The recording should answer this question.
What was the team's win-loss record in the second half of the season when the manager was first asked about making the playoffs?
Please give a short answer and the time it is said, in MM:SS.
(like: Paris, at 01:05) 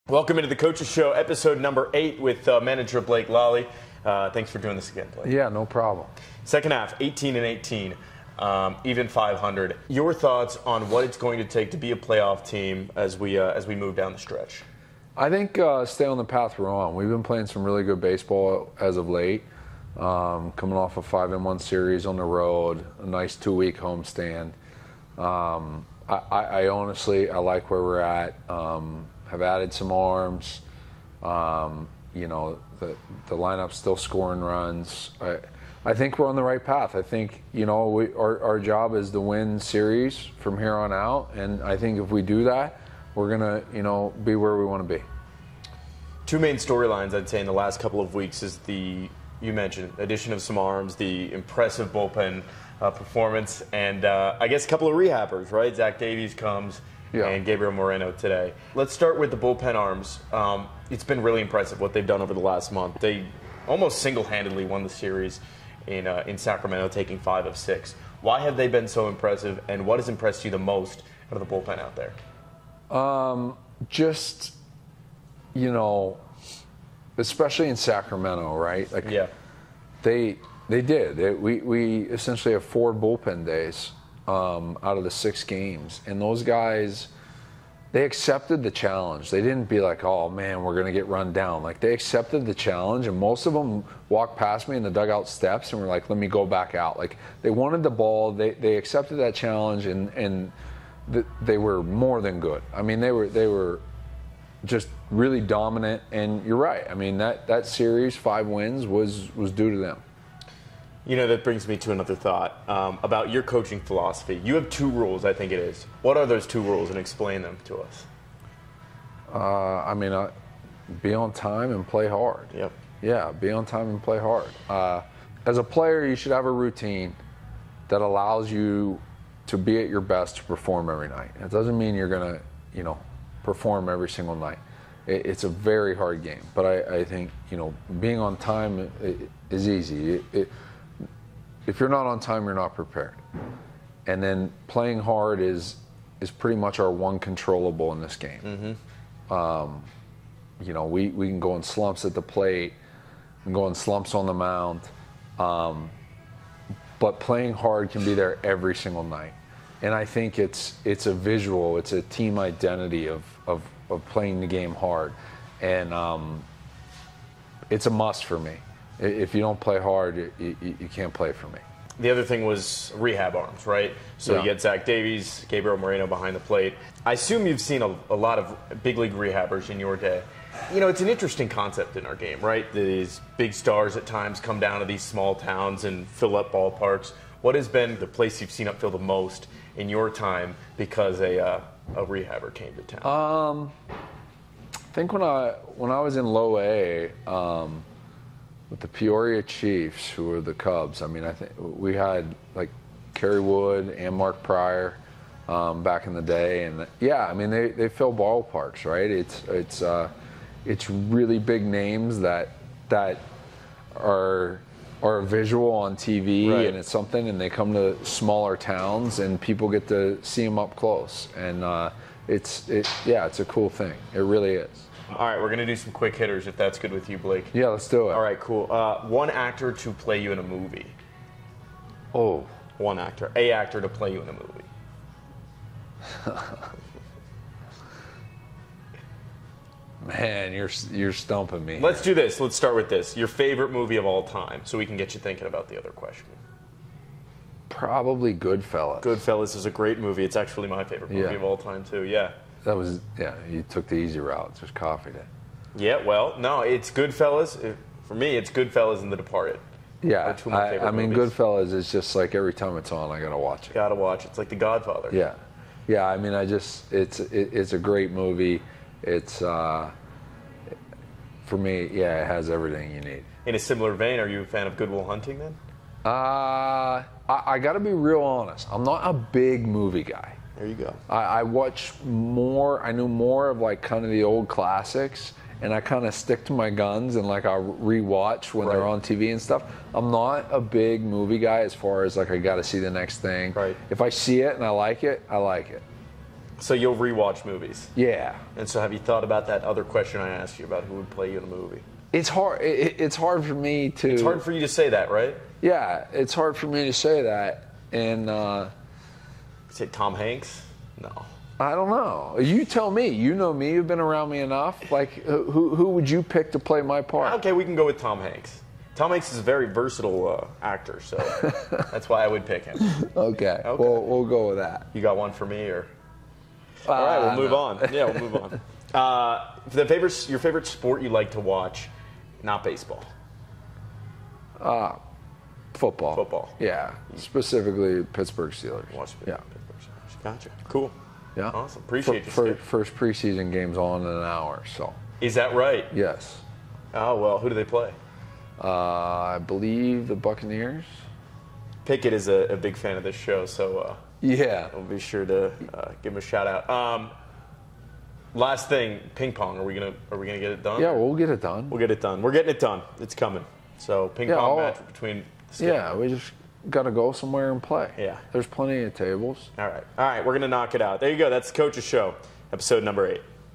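18 and 18, at 00:06.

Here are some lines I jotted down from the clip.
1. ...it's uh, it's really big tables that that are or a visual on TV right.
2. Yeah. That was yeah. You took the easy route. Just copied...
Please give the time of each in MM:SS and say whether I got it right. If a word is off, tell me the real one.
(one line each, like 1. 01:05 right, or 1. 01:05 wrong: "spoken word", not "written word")
1. 03:29 wrong: "names", not "tables"
2. 04:12 right.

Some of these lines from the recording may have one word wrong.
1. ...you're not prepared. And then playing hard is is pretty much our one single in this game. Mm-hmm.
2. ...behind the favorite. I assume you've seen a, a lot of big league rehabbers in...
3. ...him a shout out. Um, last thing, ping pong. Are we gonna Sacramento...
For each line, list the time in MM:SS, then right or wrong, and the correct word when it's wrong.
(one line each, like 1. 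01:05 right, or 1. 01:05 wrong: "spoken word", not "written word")
1. 02:22 wrong: "controllable", not "single"
2. 02:56 wrong: "plate", not "favorite"
3. 05:56 wrong: "Are", not "Sacramento".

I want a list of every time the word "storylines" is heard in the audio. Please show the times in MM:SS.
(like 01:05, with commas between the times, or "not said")
00:46.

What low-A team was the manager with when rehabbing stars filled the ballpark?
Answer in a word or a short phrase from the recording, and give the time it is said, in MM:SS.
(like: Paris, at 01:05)
Peoria Chiefs, at 03:18.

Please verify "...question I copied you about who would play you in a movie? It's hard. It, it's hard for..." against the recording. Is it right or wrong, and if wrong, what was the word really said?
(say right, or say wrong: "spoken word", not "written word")
wrong: "asked", not "copied".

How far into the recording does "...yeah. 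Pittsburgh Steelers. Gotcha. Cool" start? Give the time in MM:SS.
05:39.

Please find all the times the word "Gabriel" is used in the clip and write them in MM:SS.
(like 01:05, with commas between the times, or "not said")
00:57, 02:55.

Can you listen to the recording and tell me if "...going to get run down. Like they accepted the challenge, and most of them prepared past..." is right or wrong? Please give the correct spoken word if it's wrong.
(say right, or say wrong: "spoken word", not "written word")
wrong: "walked", not "prepared".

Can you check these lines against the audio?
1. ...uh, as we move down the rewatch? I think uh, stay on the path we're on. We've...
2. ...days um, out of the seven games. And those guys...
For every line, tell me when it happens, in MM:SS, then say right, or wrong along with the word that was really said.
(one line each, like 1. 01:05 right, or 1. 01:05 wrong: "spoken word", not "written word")
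1. 00:13 wrong: "stretch", not "rewatch"
2. 01:23 wrong: "six", not "seven".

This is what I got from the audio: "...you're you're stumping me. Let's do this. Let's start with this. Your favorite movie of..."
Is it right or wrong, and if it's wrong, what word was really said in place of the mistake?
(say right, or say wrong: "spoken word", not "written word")
right.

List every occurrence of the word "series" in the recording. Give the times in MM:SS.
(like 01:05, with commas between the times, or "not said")
00:21, 00:39, 01:04, 01:47.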